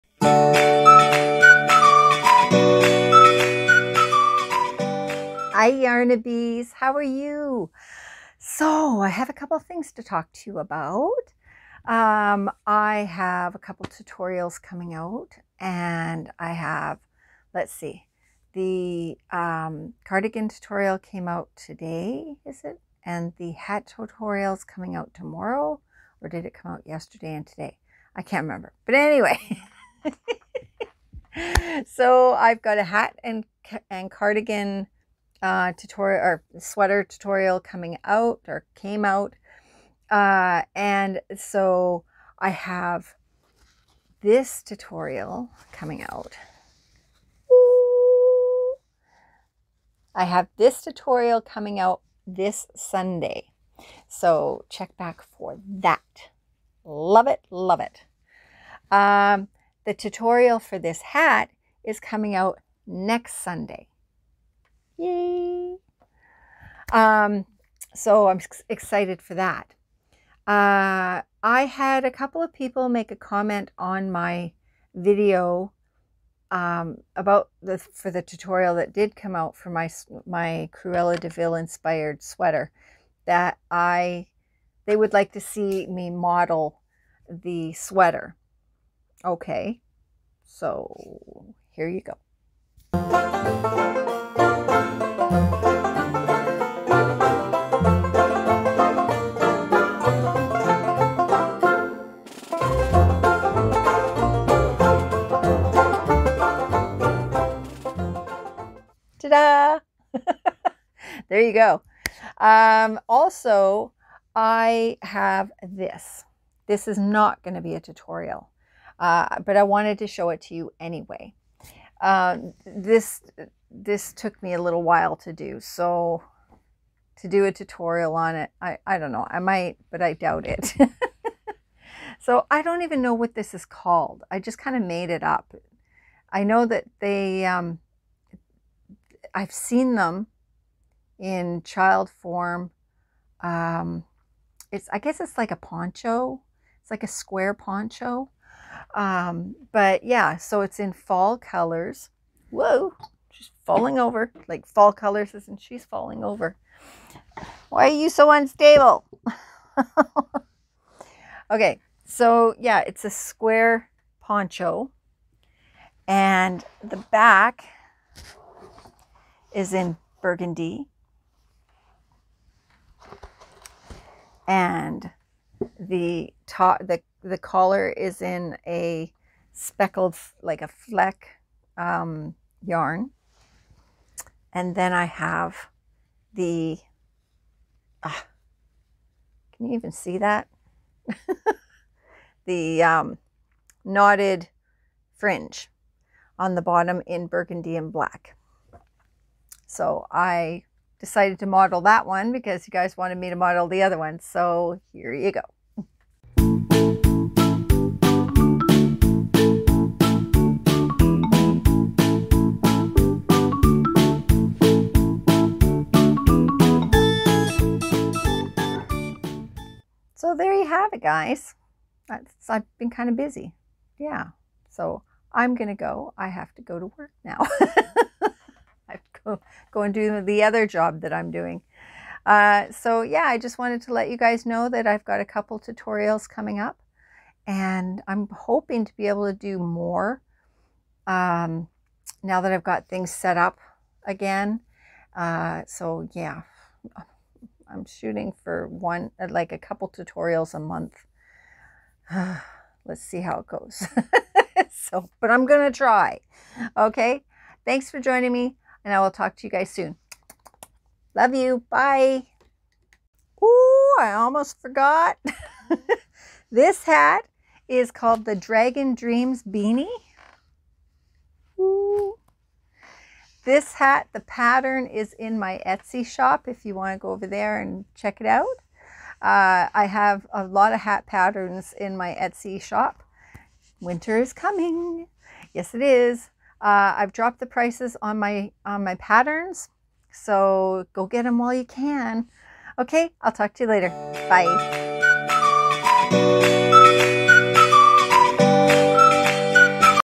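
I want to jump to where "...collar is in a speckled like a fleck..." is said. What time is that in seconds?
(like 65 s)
177 s.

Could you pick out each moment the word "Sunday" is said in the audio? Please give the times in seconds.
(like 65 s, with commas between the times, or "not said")
52 s, 63 s.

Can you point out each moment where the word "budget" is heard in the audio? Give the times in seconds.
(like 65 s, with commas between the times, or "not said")
not said.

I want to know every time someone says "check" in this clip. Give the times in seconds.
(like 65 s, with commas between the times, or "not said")
54 s, 277 s.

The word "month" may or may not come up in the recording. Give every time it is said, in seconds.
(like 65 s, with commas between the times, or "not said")
250 s.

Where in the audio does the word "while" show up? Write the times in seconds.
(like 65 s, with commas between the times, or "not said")
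124 s, 291 s.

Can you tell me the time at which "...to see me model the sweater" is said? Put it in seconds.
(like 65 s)
85 s.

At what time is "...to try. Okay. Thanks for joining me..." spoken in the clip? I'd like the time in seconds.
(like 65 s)
255 s.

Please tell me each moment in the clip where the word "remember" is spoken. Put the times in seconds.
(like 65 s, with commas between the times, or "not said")
28 s.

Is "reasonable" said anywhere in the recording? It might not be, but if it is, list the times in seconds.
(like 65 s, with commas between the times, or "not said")
not said.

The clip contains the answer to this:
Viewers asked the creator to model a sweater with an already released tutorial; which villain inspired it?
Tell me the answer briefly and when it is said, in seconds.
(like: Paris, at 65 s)
Cruella, at 80 s.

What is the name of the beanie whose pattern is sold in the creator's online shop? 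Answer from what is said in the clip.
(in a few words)
Dragon Dreams Beanie.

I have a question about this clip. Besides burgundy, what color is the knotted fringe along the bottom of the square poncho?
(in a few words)
black.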